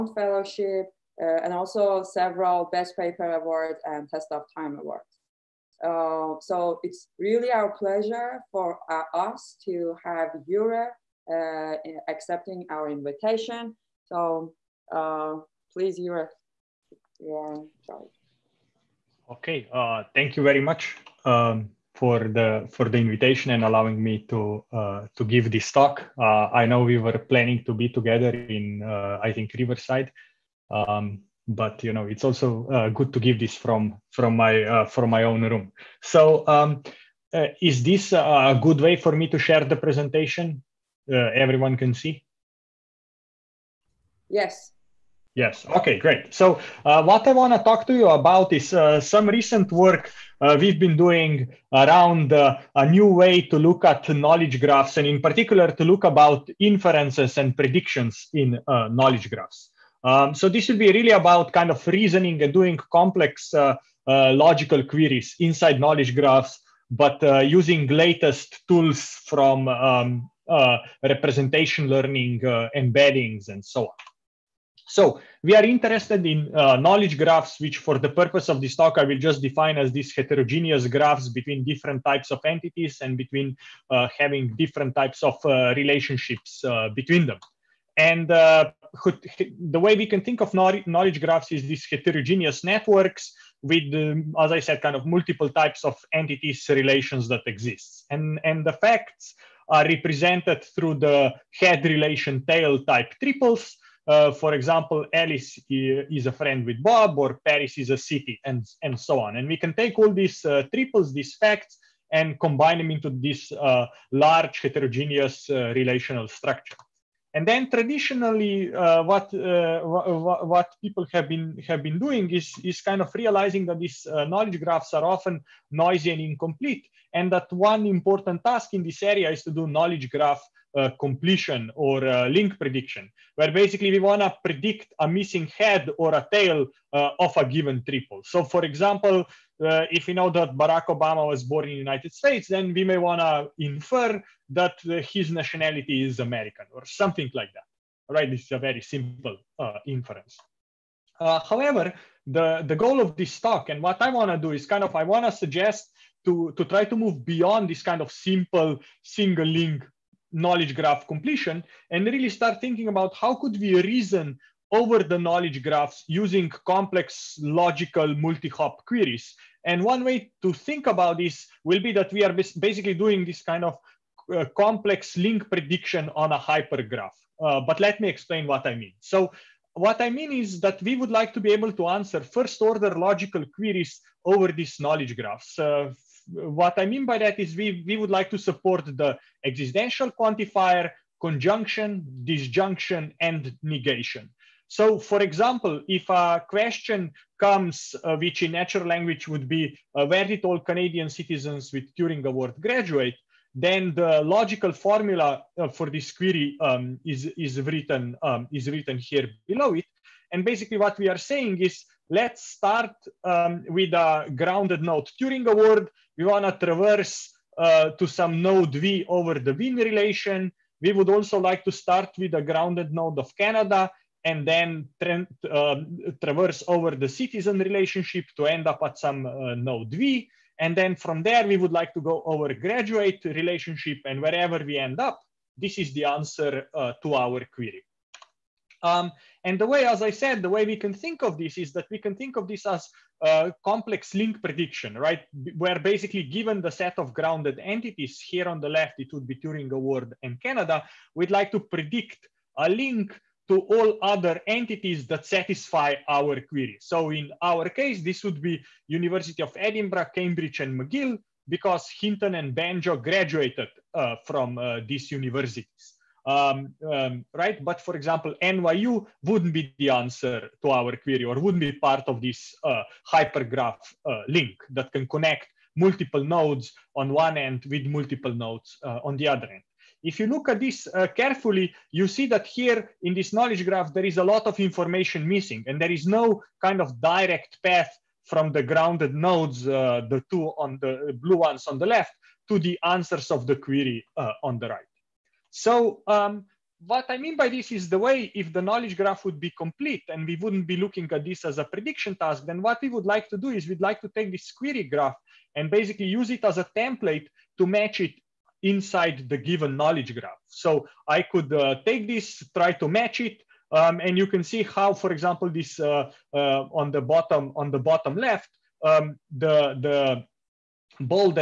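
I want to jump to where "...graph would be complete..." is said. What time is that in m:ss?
4:58.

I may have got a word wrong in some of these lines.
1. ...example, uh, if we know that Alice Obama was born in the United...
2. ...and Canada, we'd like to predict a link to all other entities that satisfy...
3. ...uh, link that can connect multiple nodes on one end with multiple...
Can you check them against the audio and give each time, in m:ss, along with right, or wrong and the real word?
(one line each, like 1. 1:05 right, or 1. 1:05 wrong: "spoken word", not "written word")
1. 2:18 wrong: "Barack", not "Alice"
2. 4:10 right
3. 4:34 right.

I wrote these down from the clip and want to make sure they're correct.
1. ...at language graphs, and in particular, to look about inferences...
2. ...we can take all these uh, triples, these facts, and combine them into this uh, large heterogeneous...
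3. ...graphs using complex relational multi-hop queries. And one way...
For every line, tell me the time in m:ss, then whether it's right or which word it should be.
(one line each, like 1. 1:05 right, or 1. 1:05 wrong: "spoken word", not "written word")
1. 0:53 wrong: "knowledge", not "language"
2. 1:49 right
3. 2:45 wrong: "logical", not "relational".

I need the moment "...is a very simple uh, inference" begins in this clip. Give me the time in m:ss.
2:28.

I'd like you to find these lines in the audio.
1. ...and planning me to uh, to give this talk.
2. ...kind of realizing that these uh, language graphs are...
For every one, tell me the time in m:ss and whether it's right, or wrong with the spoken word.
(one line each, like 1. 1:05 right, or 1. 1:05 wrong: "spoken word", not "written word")
1. 0:23 wrong: "allowing", not "planning"
2. 2:02 wrong: "knowledge", not "language".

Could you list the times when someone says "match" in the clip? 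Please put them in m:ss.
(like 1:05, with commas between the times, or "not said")
5:07, 5:12.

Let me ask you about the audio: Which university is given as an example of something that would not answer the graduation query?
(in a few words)
NYU.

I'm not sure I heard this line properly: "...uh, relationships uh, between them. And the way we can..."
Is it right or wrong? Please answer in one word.
right.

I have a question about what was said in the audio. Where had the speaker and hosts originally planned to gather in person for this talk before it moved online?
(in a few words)
Riverside.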